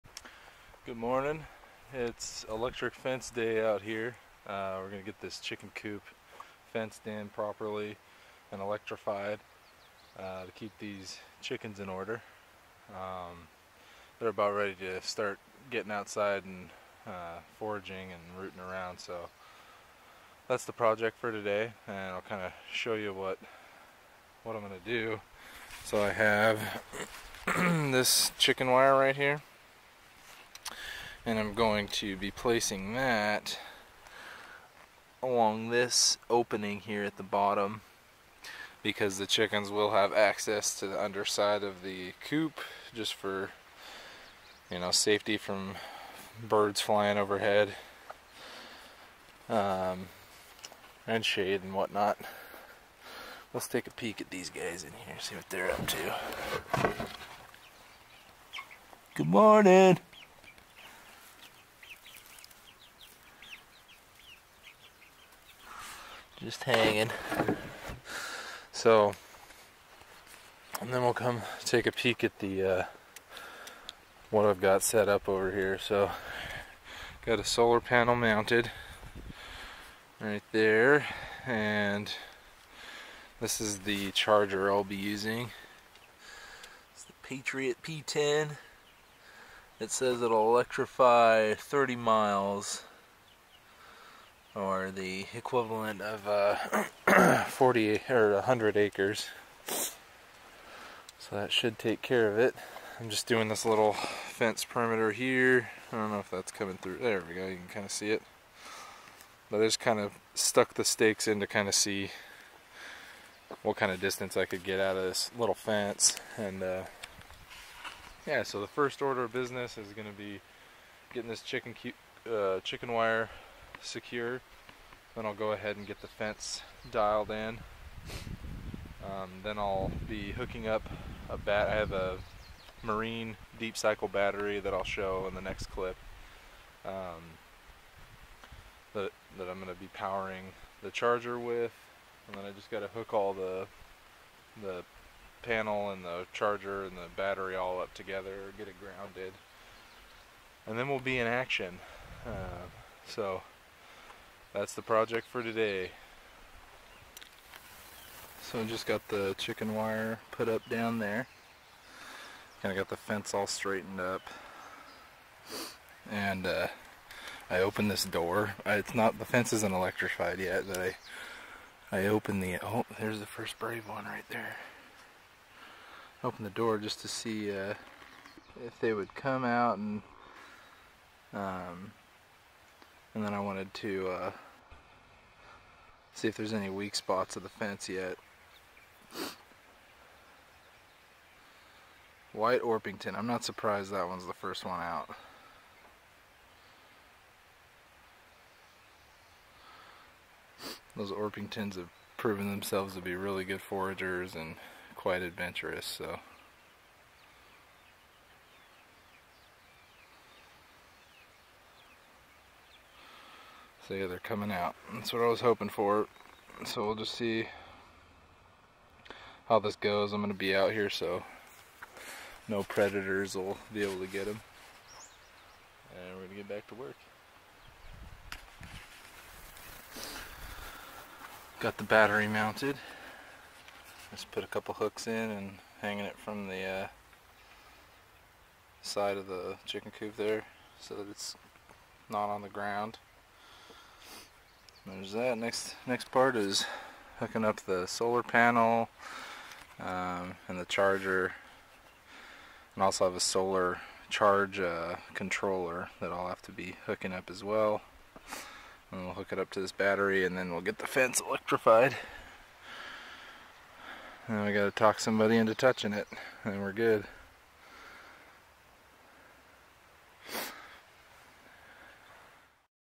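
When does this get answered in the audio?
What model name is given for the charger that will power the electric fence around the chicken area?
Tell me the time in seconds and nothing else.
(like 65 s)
87 s.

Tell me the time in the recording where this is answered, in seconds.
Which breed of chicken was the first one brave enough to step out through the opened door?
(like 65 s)
192 s.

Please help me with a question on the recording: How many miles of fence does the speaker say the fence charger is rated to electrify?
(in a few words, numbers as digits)
30.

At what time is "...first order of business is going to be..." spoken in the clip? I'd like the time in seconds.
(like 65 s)
118 s.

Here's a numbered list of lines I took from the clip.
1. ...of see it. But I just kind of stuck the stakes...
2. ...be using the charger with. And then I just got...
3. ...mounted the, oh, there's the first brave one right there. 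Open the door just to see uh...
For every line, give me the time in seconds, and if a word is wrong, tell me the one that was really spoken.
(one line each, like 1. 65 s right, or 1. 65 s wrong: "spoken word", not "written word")
1. 107 s right
2. 139 s wrong: "powering", not "using"
3. 172 s wrong: "opened", not "mounted".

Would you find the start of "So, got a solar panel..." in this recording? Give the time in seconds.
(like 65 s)
75 s.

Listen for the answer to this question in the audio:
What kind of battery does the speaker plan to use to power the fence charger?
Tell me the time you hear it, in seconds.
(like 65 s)
132 s.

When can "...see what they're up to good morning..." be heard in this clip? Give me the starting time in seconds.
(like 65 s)
55 s.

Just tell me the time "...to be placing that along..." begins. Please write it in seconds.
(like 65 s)
31 s.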